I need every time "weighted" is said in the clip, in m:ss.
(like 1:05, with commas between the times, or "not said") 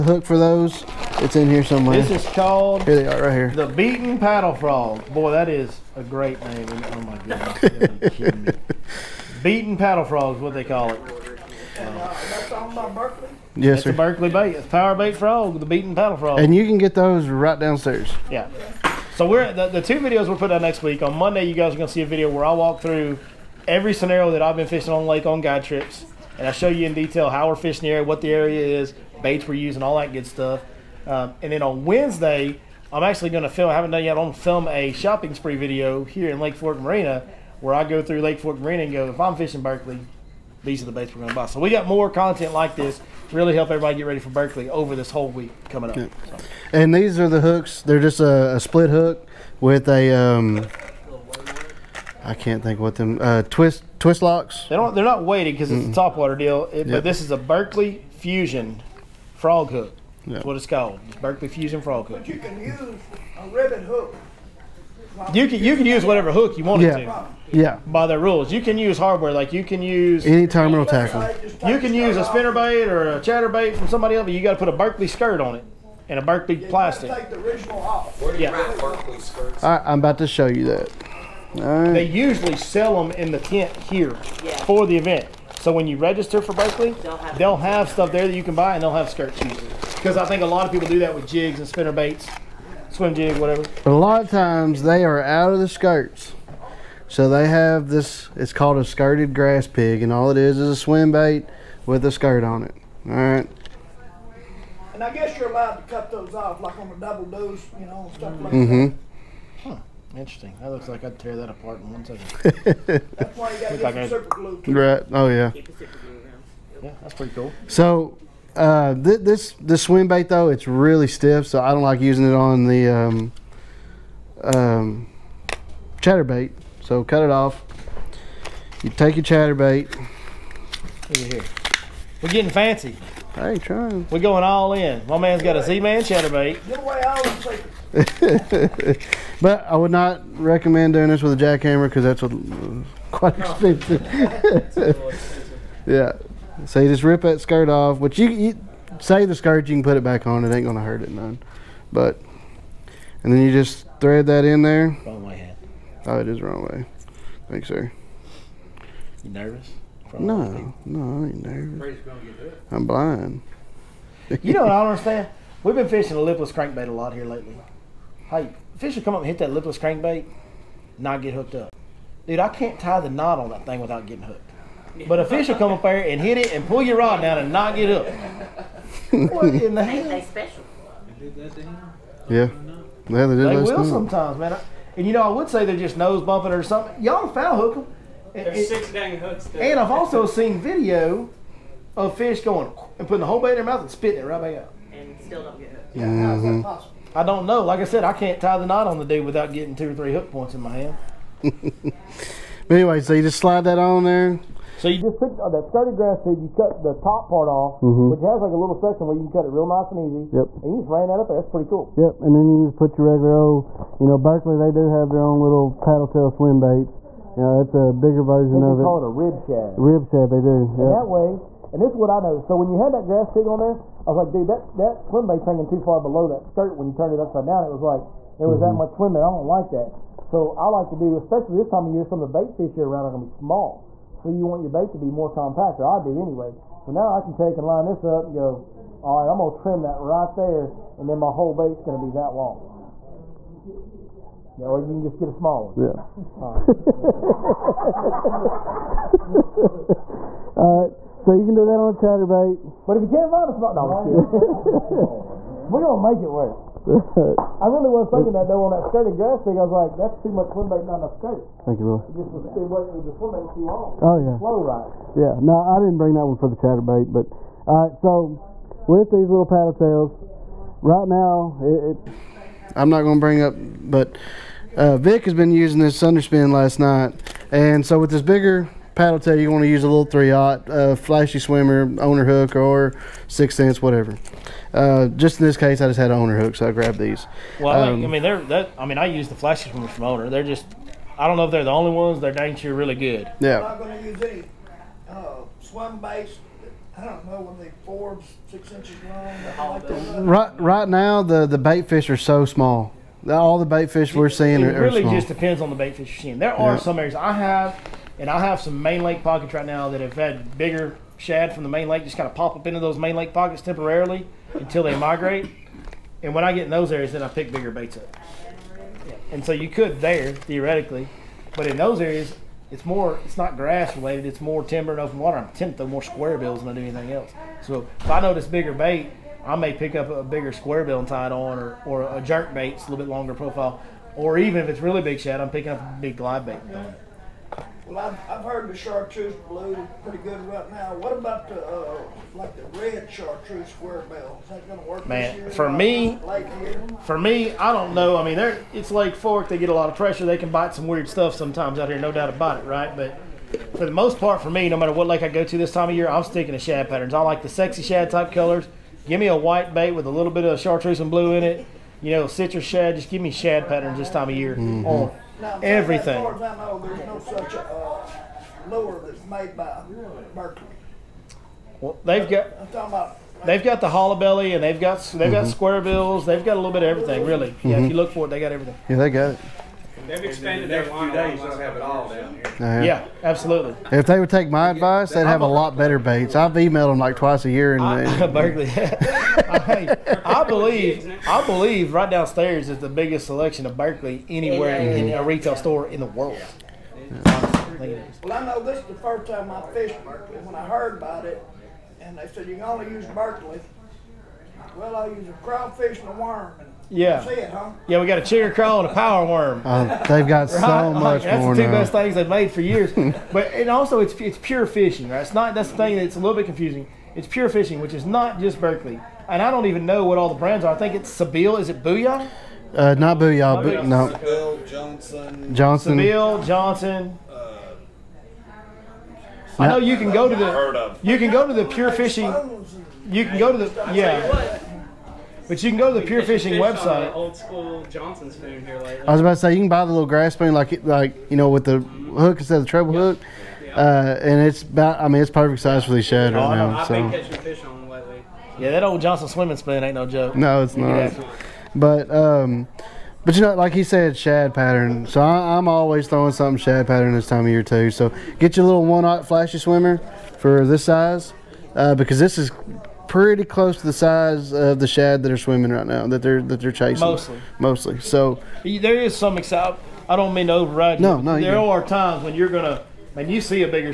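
0:55.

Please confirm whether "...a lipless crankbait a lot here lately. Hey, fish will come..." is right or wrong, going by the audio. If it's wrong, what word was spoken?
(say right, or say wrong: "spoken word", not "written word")
right.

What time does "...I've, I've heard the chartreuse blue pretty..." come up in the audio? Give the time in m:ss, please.
5:37.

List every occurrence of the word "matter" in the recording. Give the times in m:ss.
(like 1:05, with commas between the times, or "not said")
5:54.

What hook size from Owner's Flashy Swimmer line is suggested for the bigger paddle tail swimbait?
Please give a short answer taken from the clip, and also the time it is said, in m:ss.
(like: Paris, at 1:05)
3-aught, at 4:40.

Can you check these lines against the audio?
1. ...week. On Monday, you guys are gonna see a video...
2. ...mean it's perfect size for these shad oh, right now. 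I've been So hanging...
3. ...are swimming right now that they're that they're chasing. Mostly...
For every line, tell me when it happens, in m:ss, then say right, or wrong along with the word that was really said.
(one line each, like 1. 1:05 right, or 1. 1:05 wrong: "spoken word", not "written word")
1. 0:20 right
2. 7:25 wrong: "catching", not "hanging"
3. 7:45 right.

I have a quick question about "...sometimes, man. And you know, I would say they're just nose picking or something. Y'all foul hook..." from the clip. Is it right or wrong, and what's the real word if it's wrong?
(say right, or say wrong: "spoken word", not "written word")
wrong: "bumping", not "picking".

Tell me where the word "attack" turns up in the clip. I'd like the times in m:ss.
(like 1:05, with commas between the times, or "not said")
not said.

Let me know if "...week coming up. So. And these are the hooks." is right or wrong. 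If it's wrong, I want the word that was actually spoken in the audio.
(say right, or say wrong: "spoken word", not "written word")
right.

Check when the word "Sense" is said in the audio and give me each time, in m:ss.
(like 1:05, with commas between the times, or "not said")
4:43.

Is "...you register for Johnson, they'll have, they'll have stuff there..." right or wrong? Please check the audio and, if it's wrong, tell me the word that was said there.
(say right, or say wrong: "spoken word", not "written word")
wrong: "Berkley", not "Johnson".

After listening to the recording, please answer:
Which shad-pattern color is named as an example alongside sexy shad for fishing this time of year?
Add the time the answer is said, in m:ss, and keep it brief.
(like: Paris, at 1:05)
Citrus shad, at 6:02.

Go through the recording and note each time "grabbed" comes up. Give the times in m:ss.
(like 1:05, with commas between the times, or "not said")
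4:46.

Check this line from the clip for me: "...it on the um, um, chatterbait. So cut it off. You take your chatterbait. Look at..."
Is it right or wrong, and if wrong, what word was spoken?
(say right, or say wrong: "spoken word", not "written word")
right.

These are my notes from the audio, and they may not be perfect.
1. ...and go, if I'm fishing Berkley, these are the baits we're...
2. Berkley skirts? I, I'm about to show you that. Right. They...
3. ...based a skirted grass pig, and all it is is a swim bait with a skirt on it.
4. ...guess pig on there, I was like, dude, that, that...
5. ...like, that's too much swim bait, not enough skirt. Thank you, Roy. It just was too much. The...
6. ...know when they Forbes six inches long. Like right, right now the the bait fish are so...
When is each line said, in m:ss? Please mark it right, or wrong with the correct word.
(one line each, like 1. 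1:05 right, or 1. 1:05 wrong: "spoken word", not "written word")
1. 0:38 right
2. 1:18 right
3. 1:38 wrong: "called", not "based"
4. 3:43 wrong: "grass", not "guess"
5. 4:19 right
6. 4:57 right.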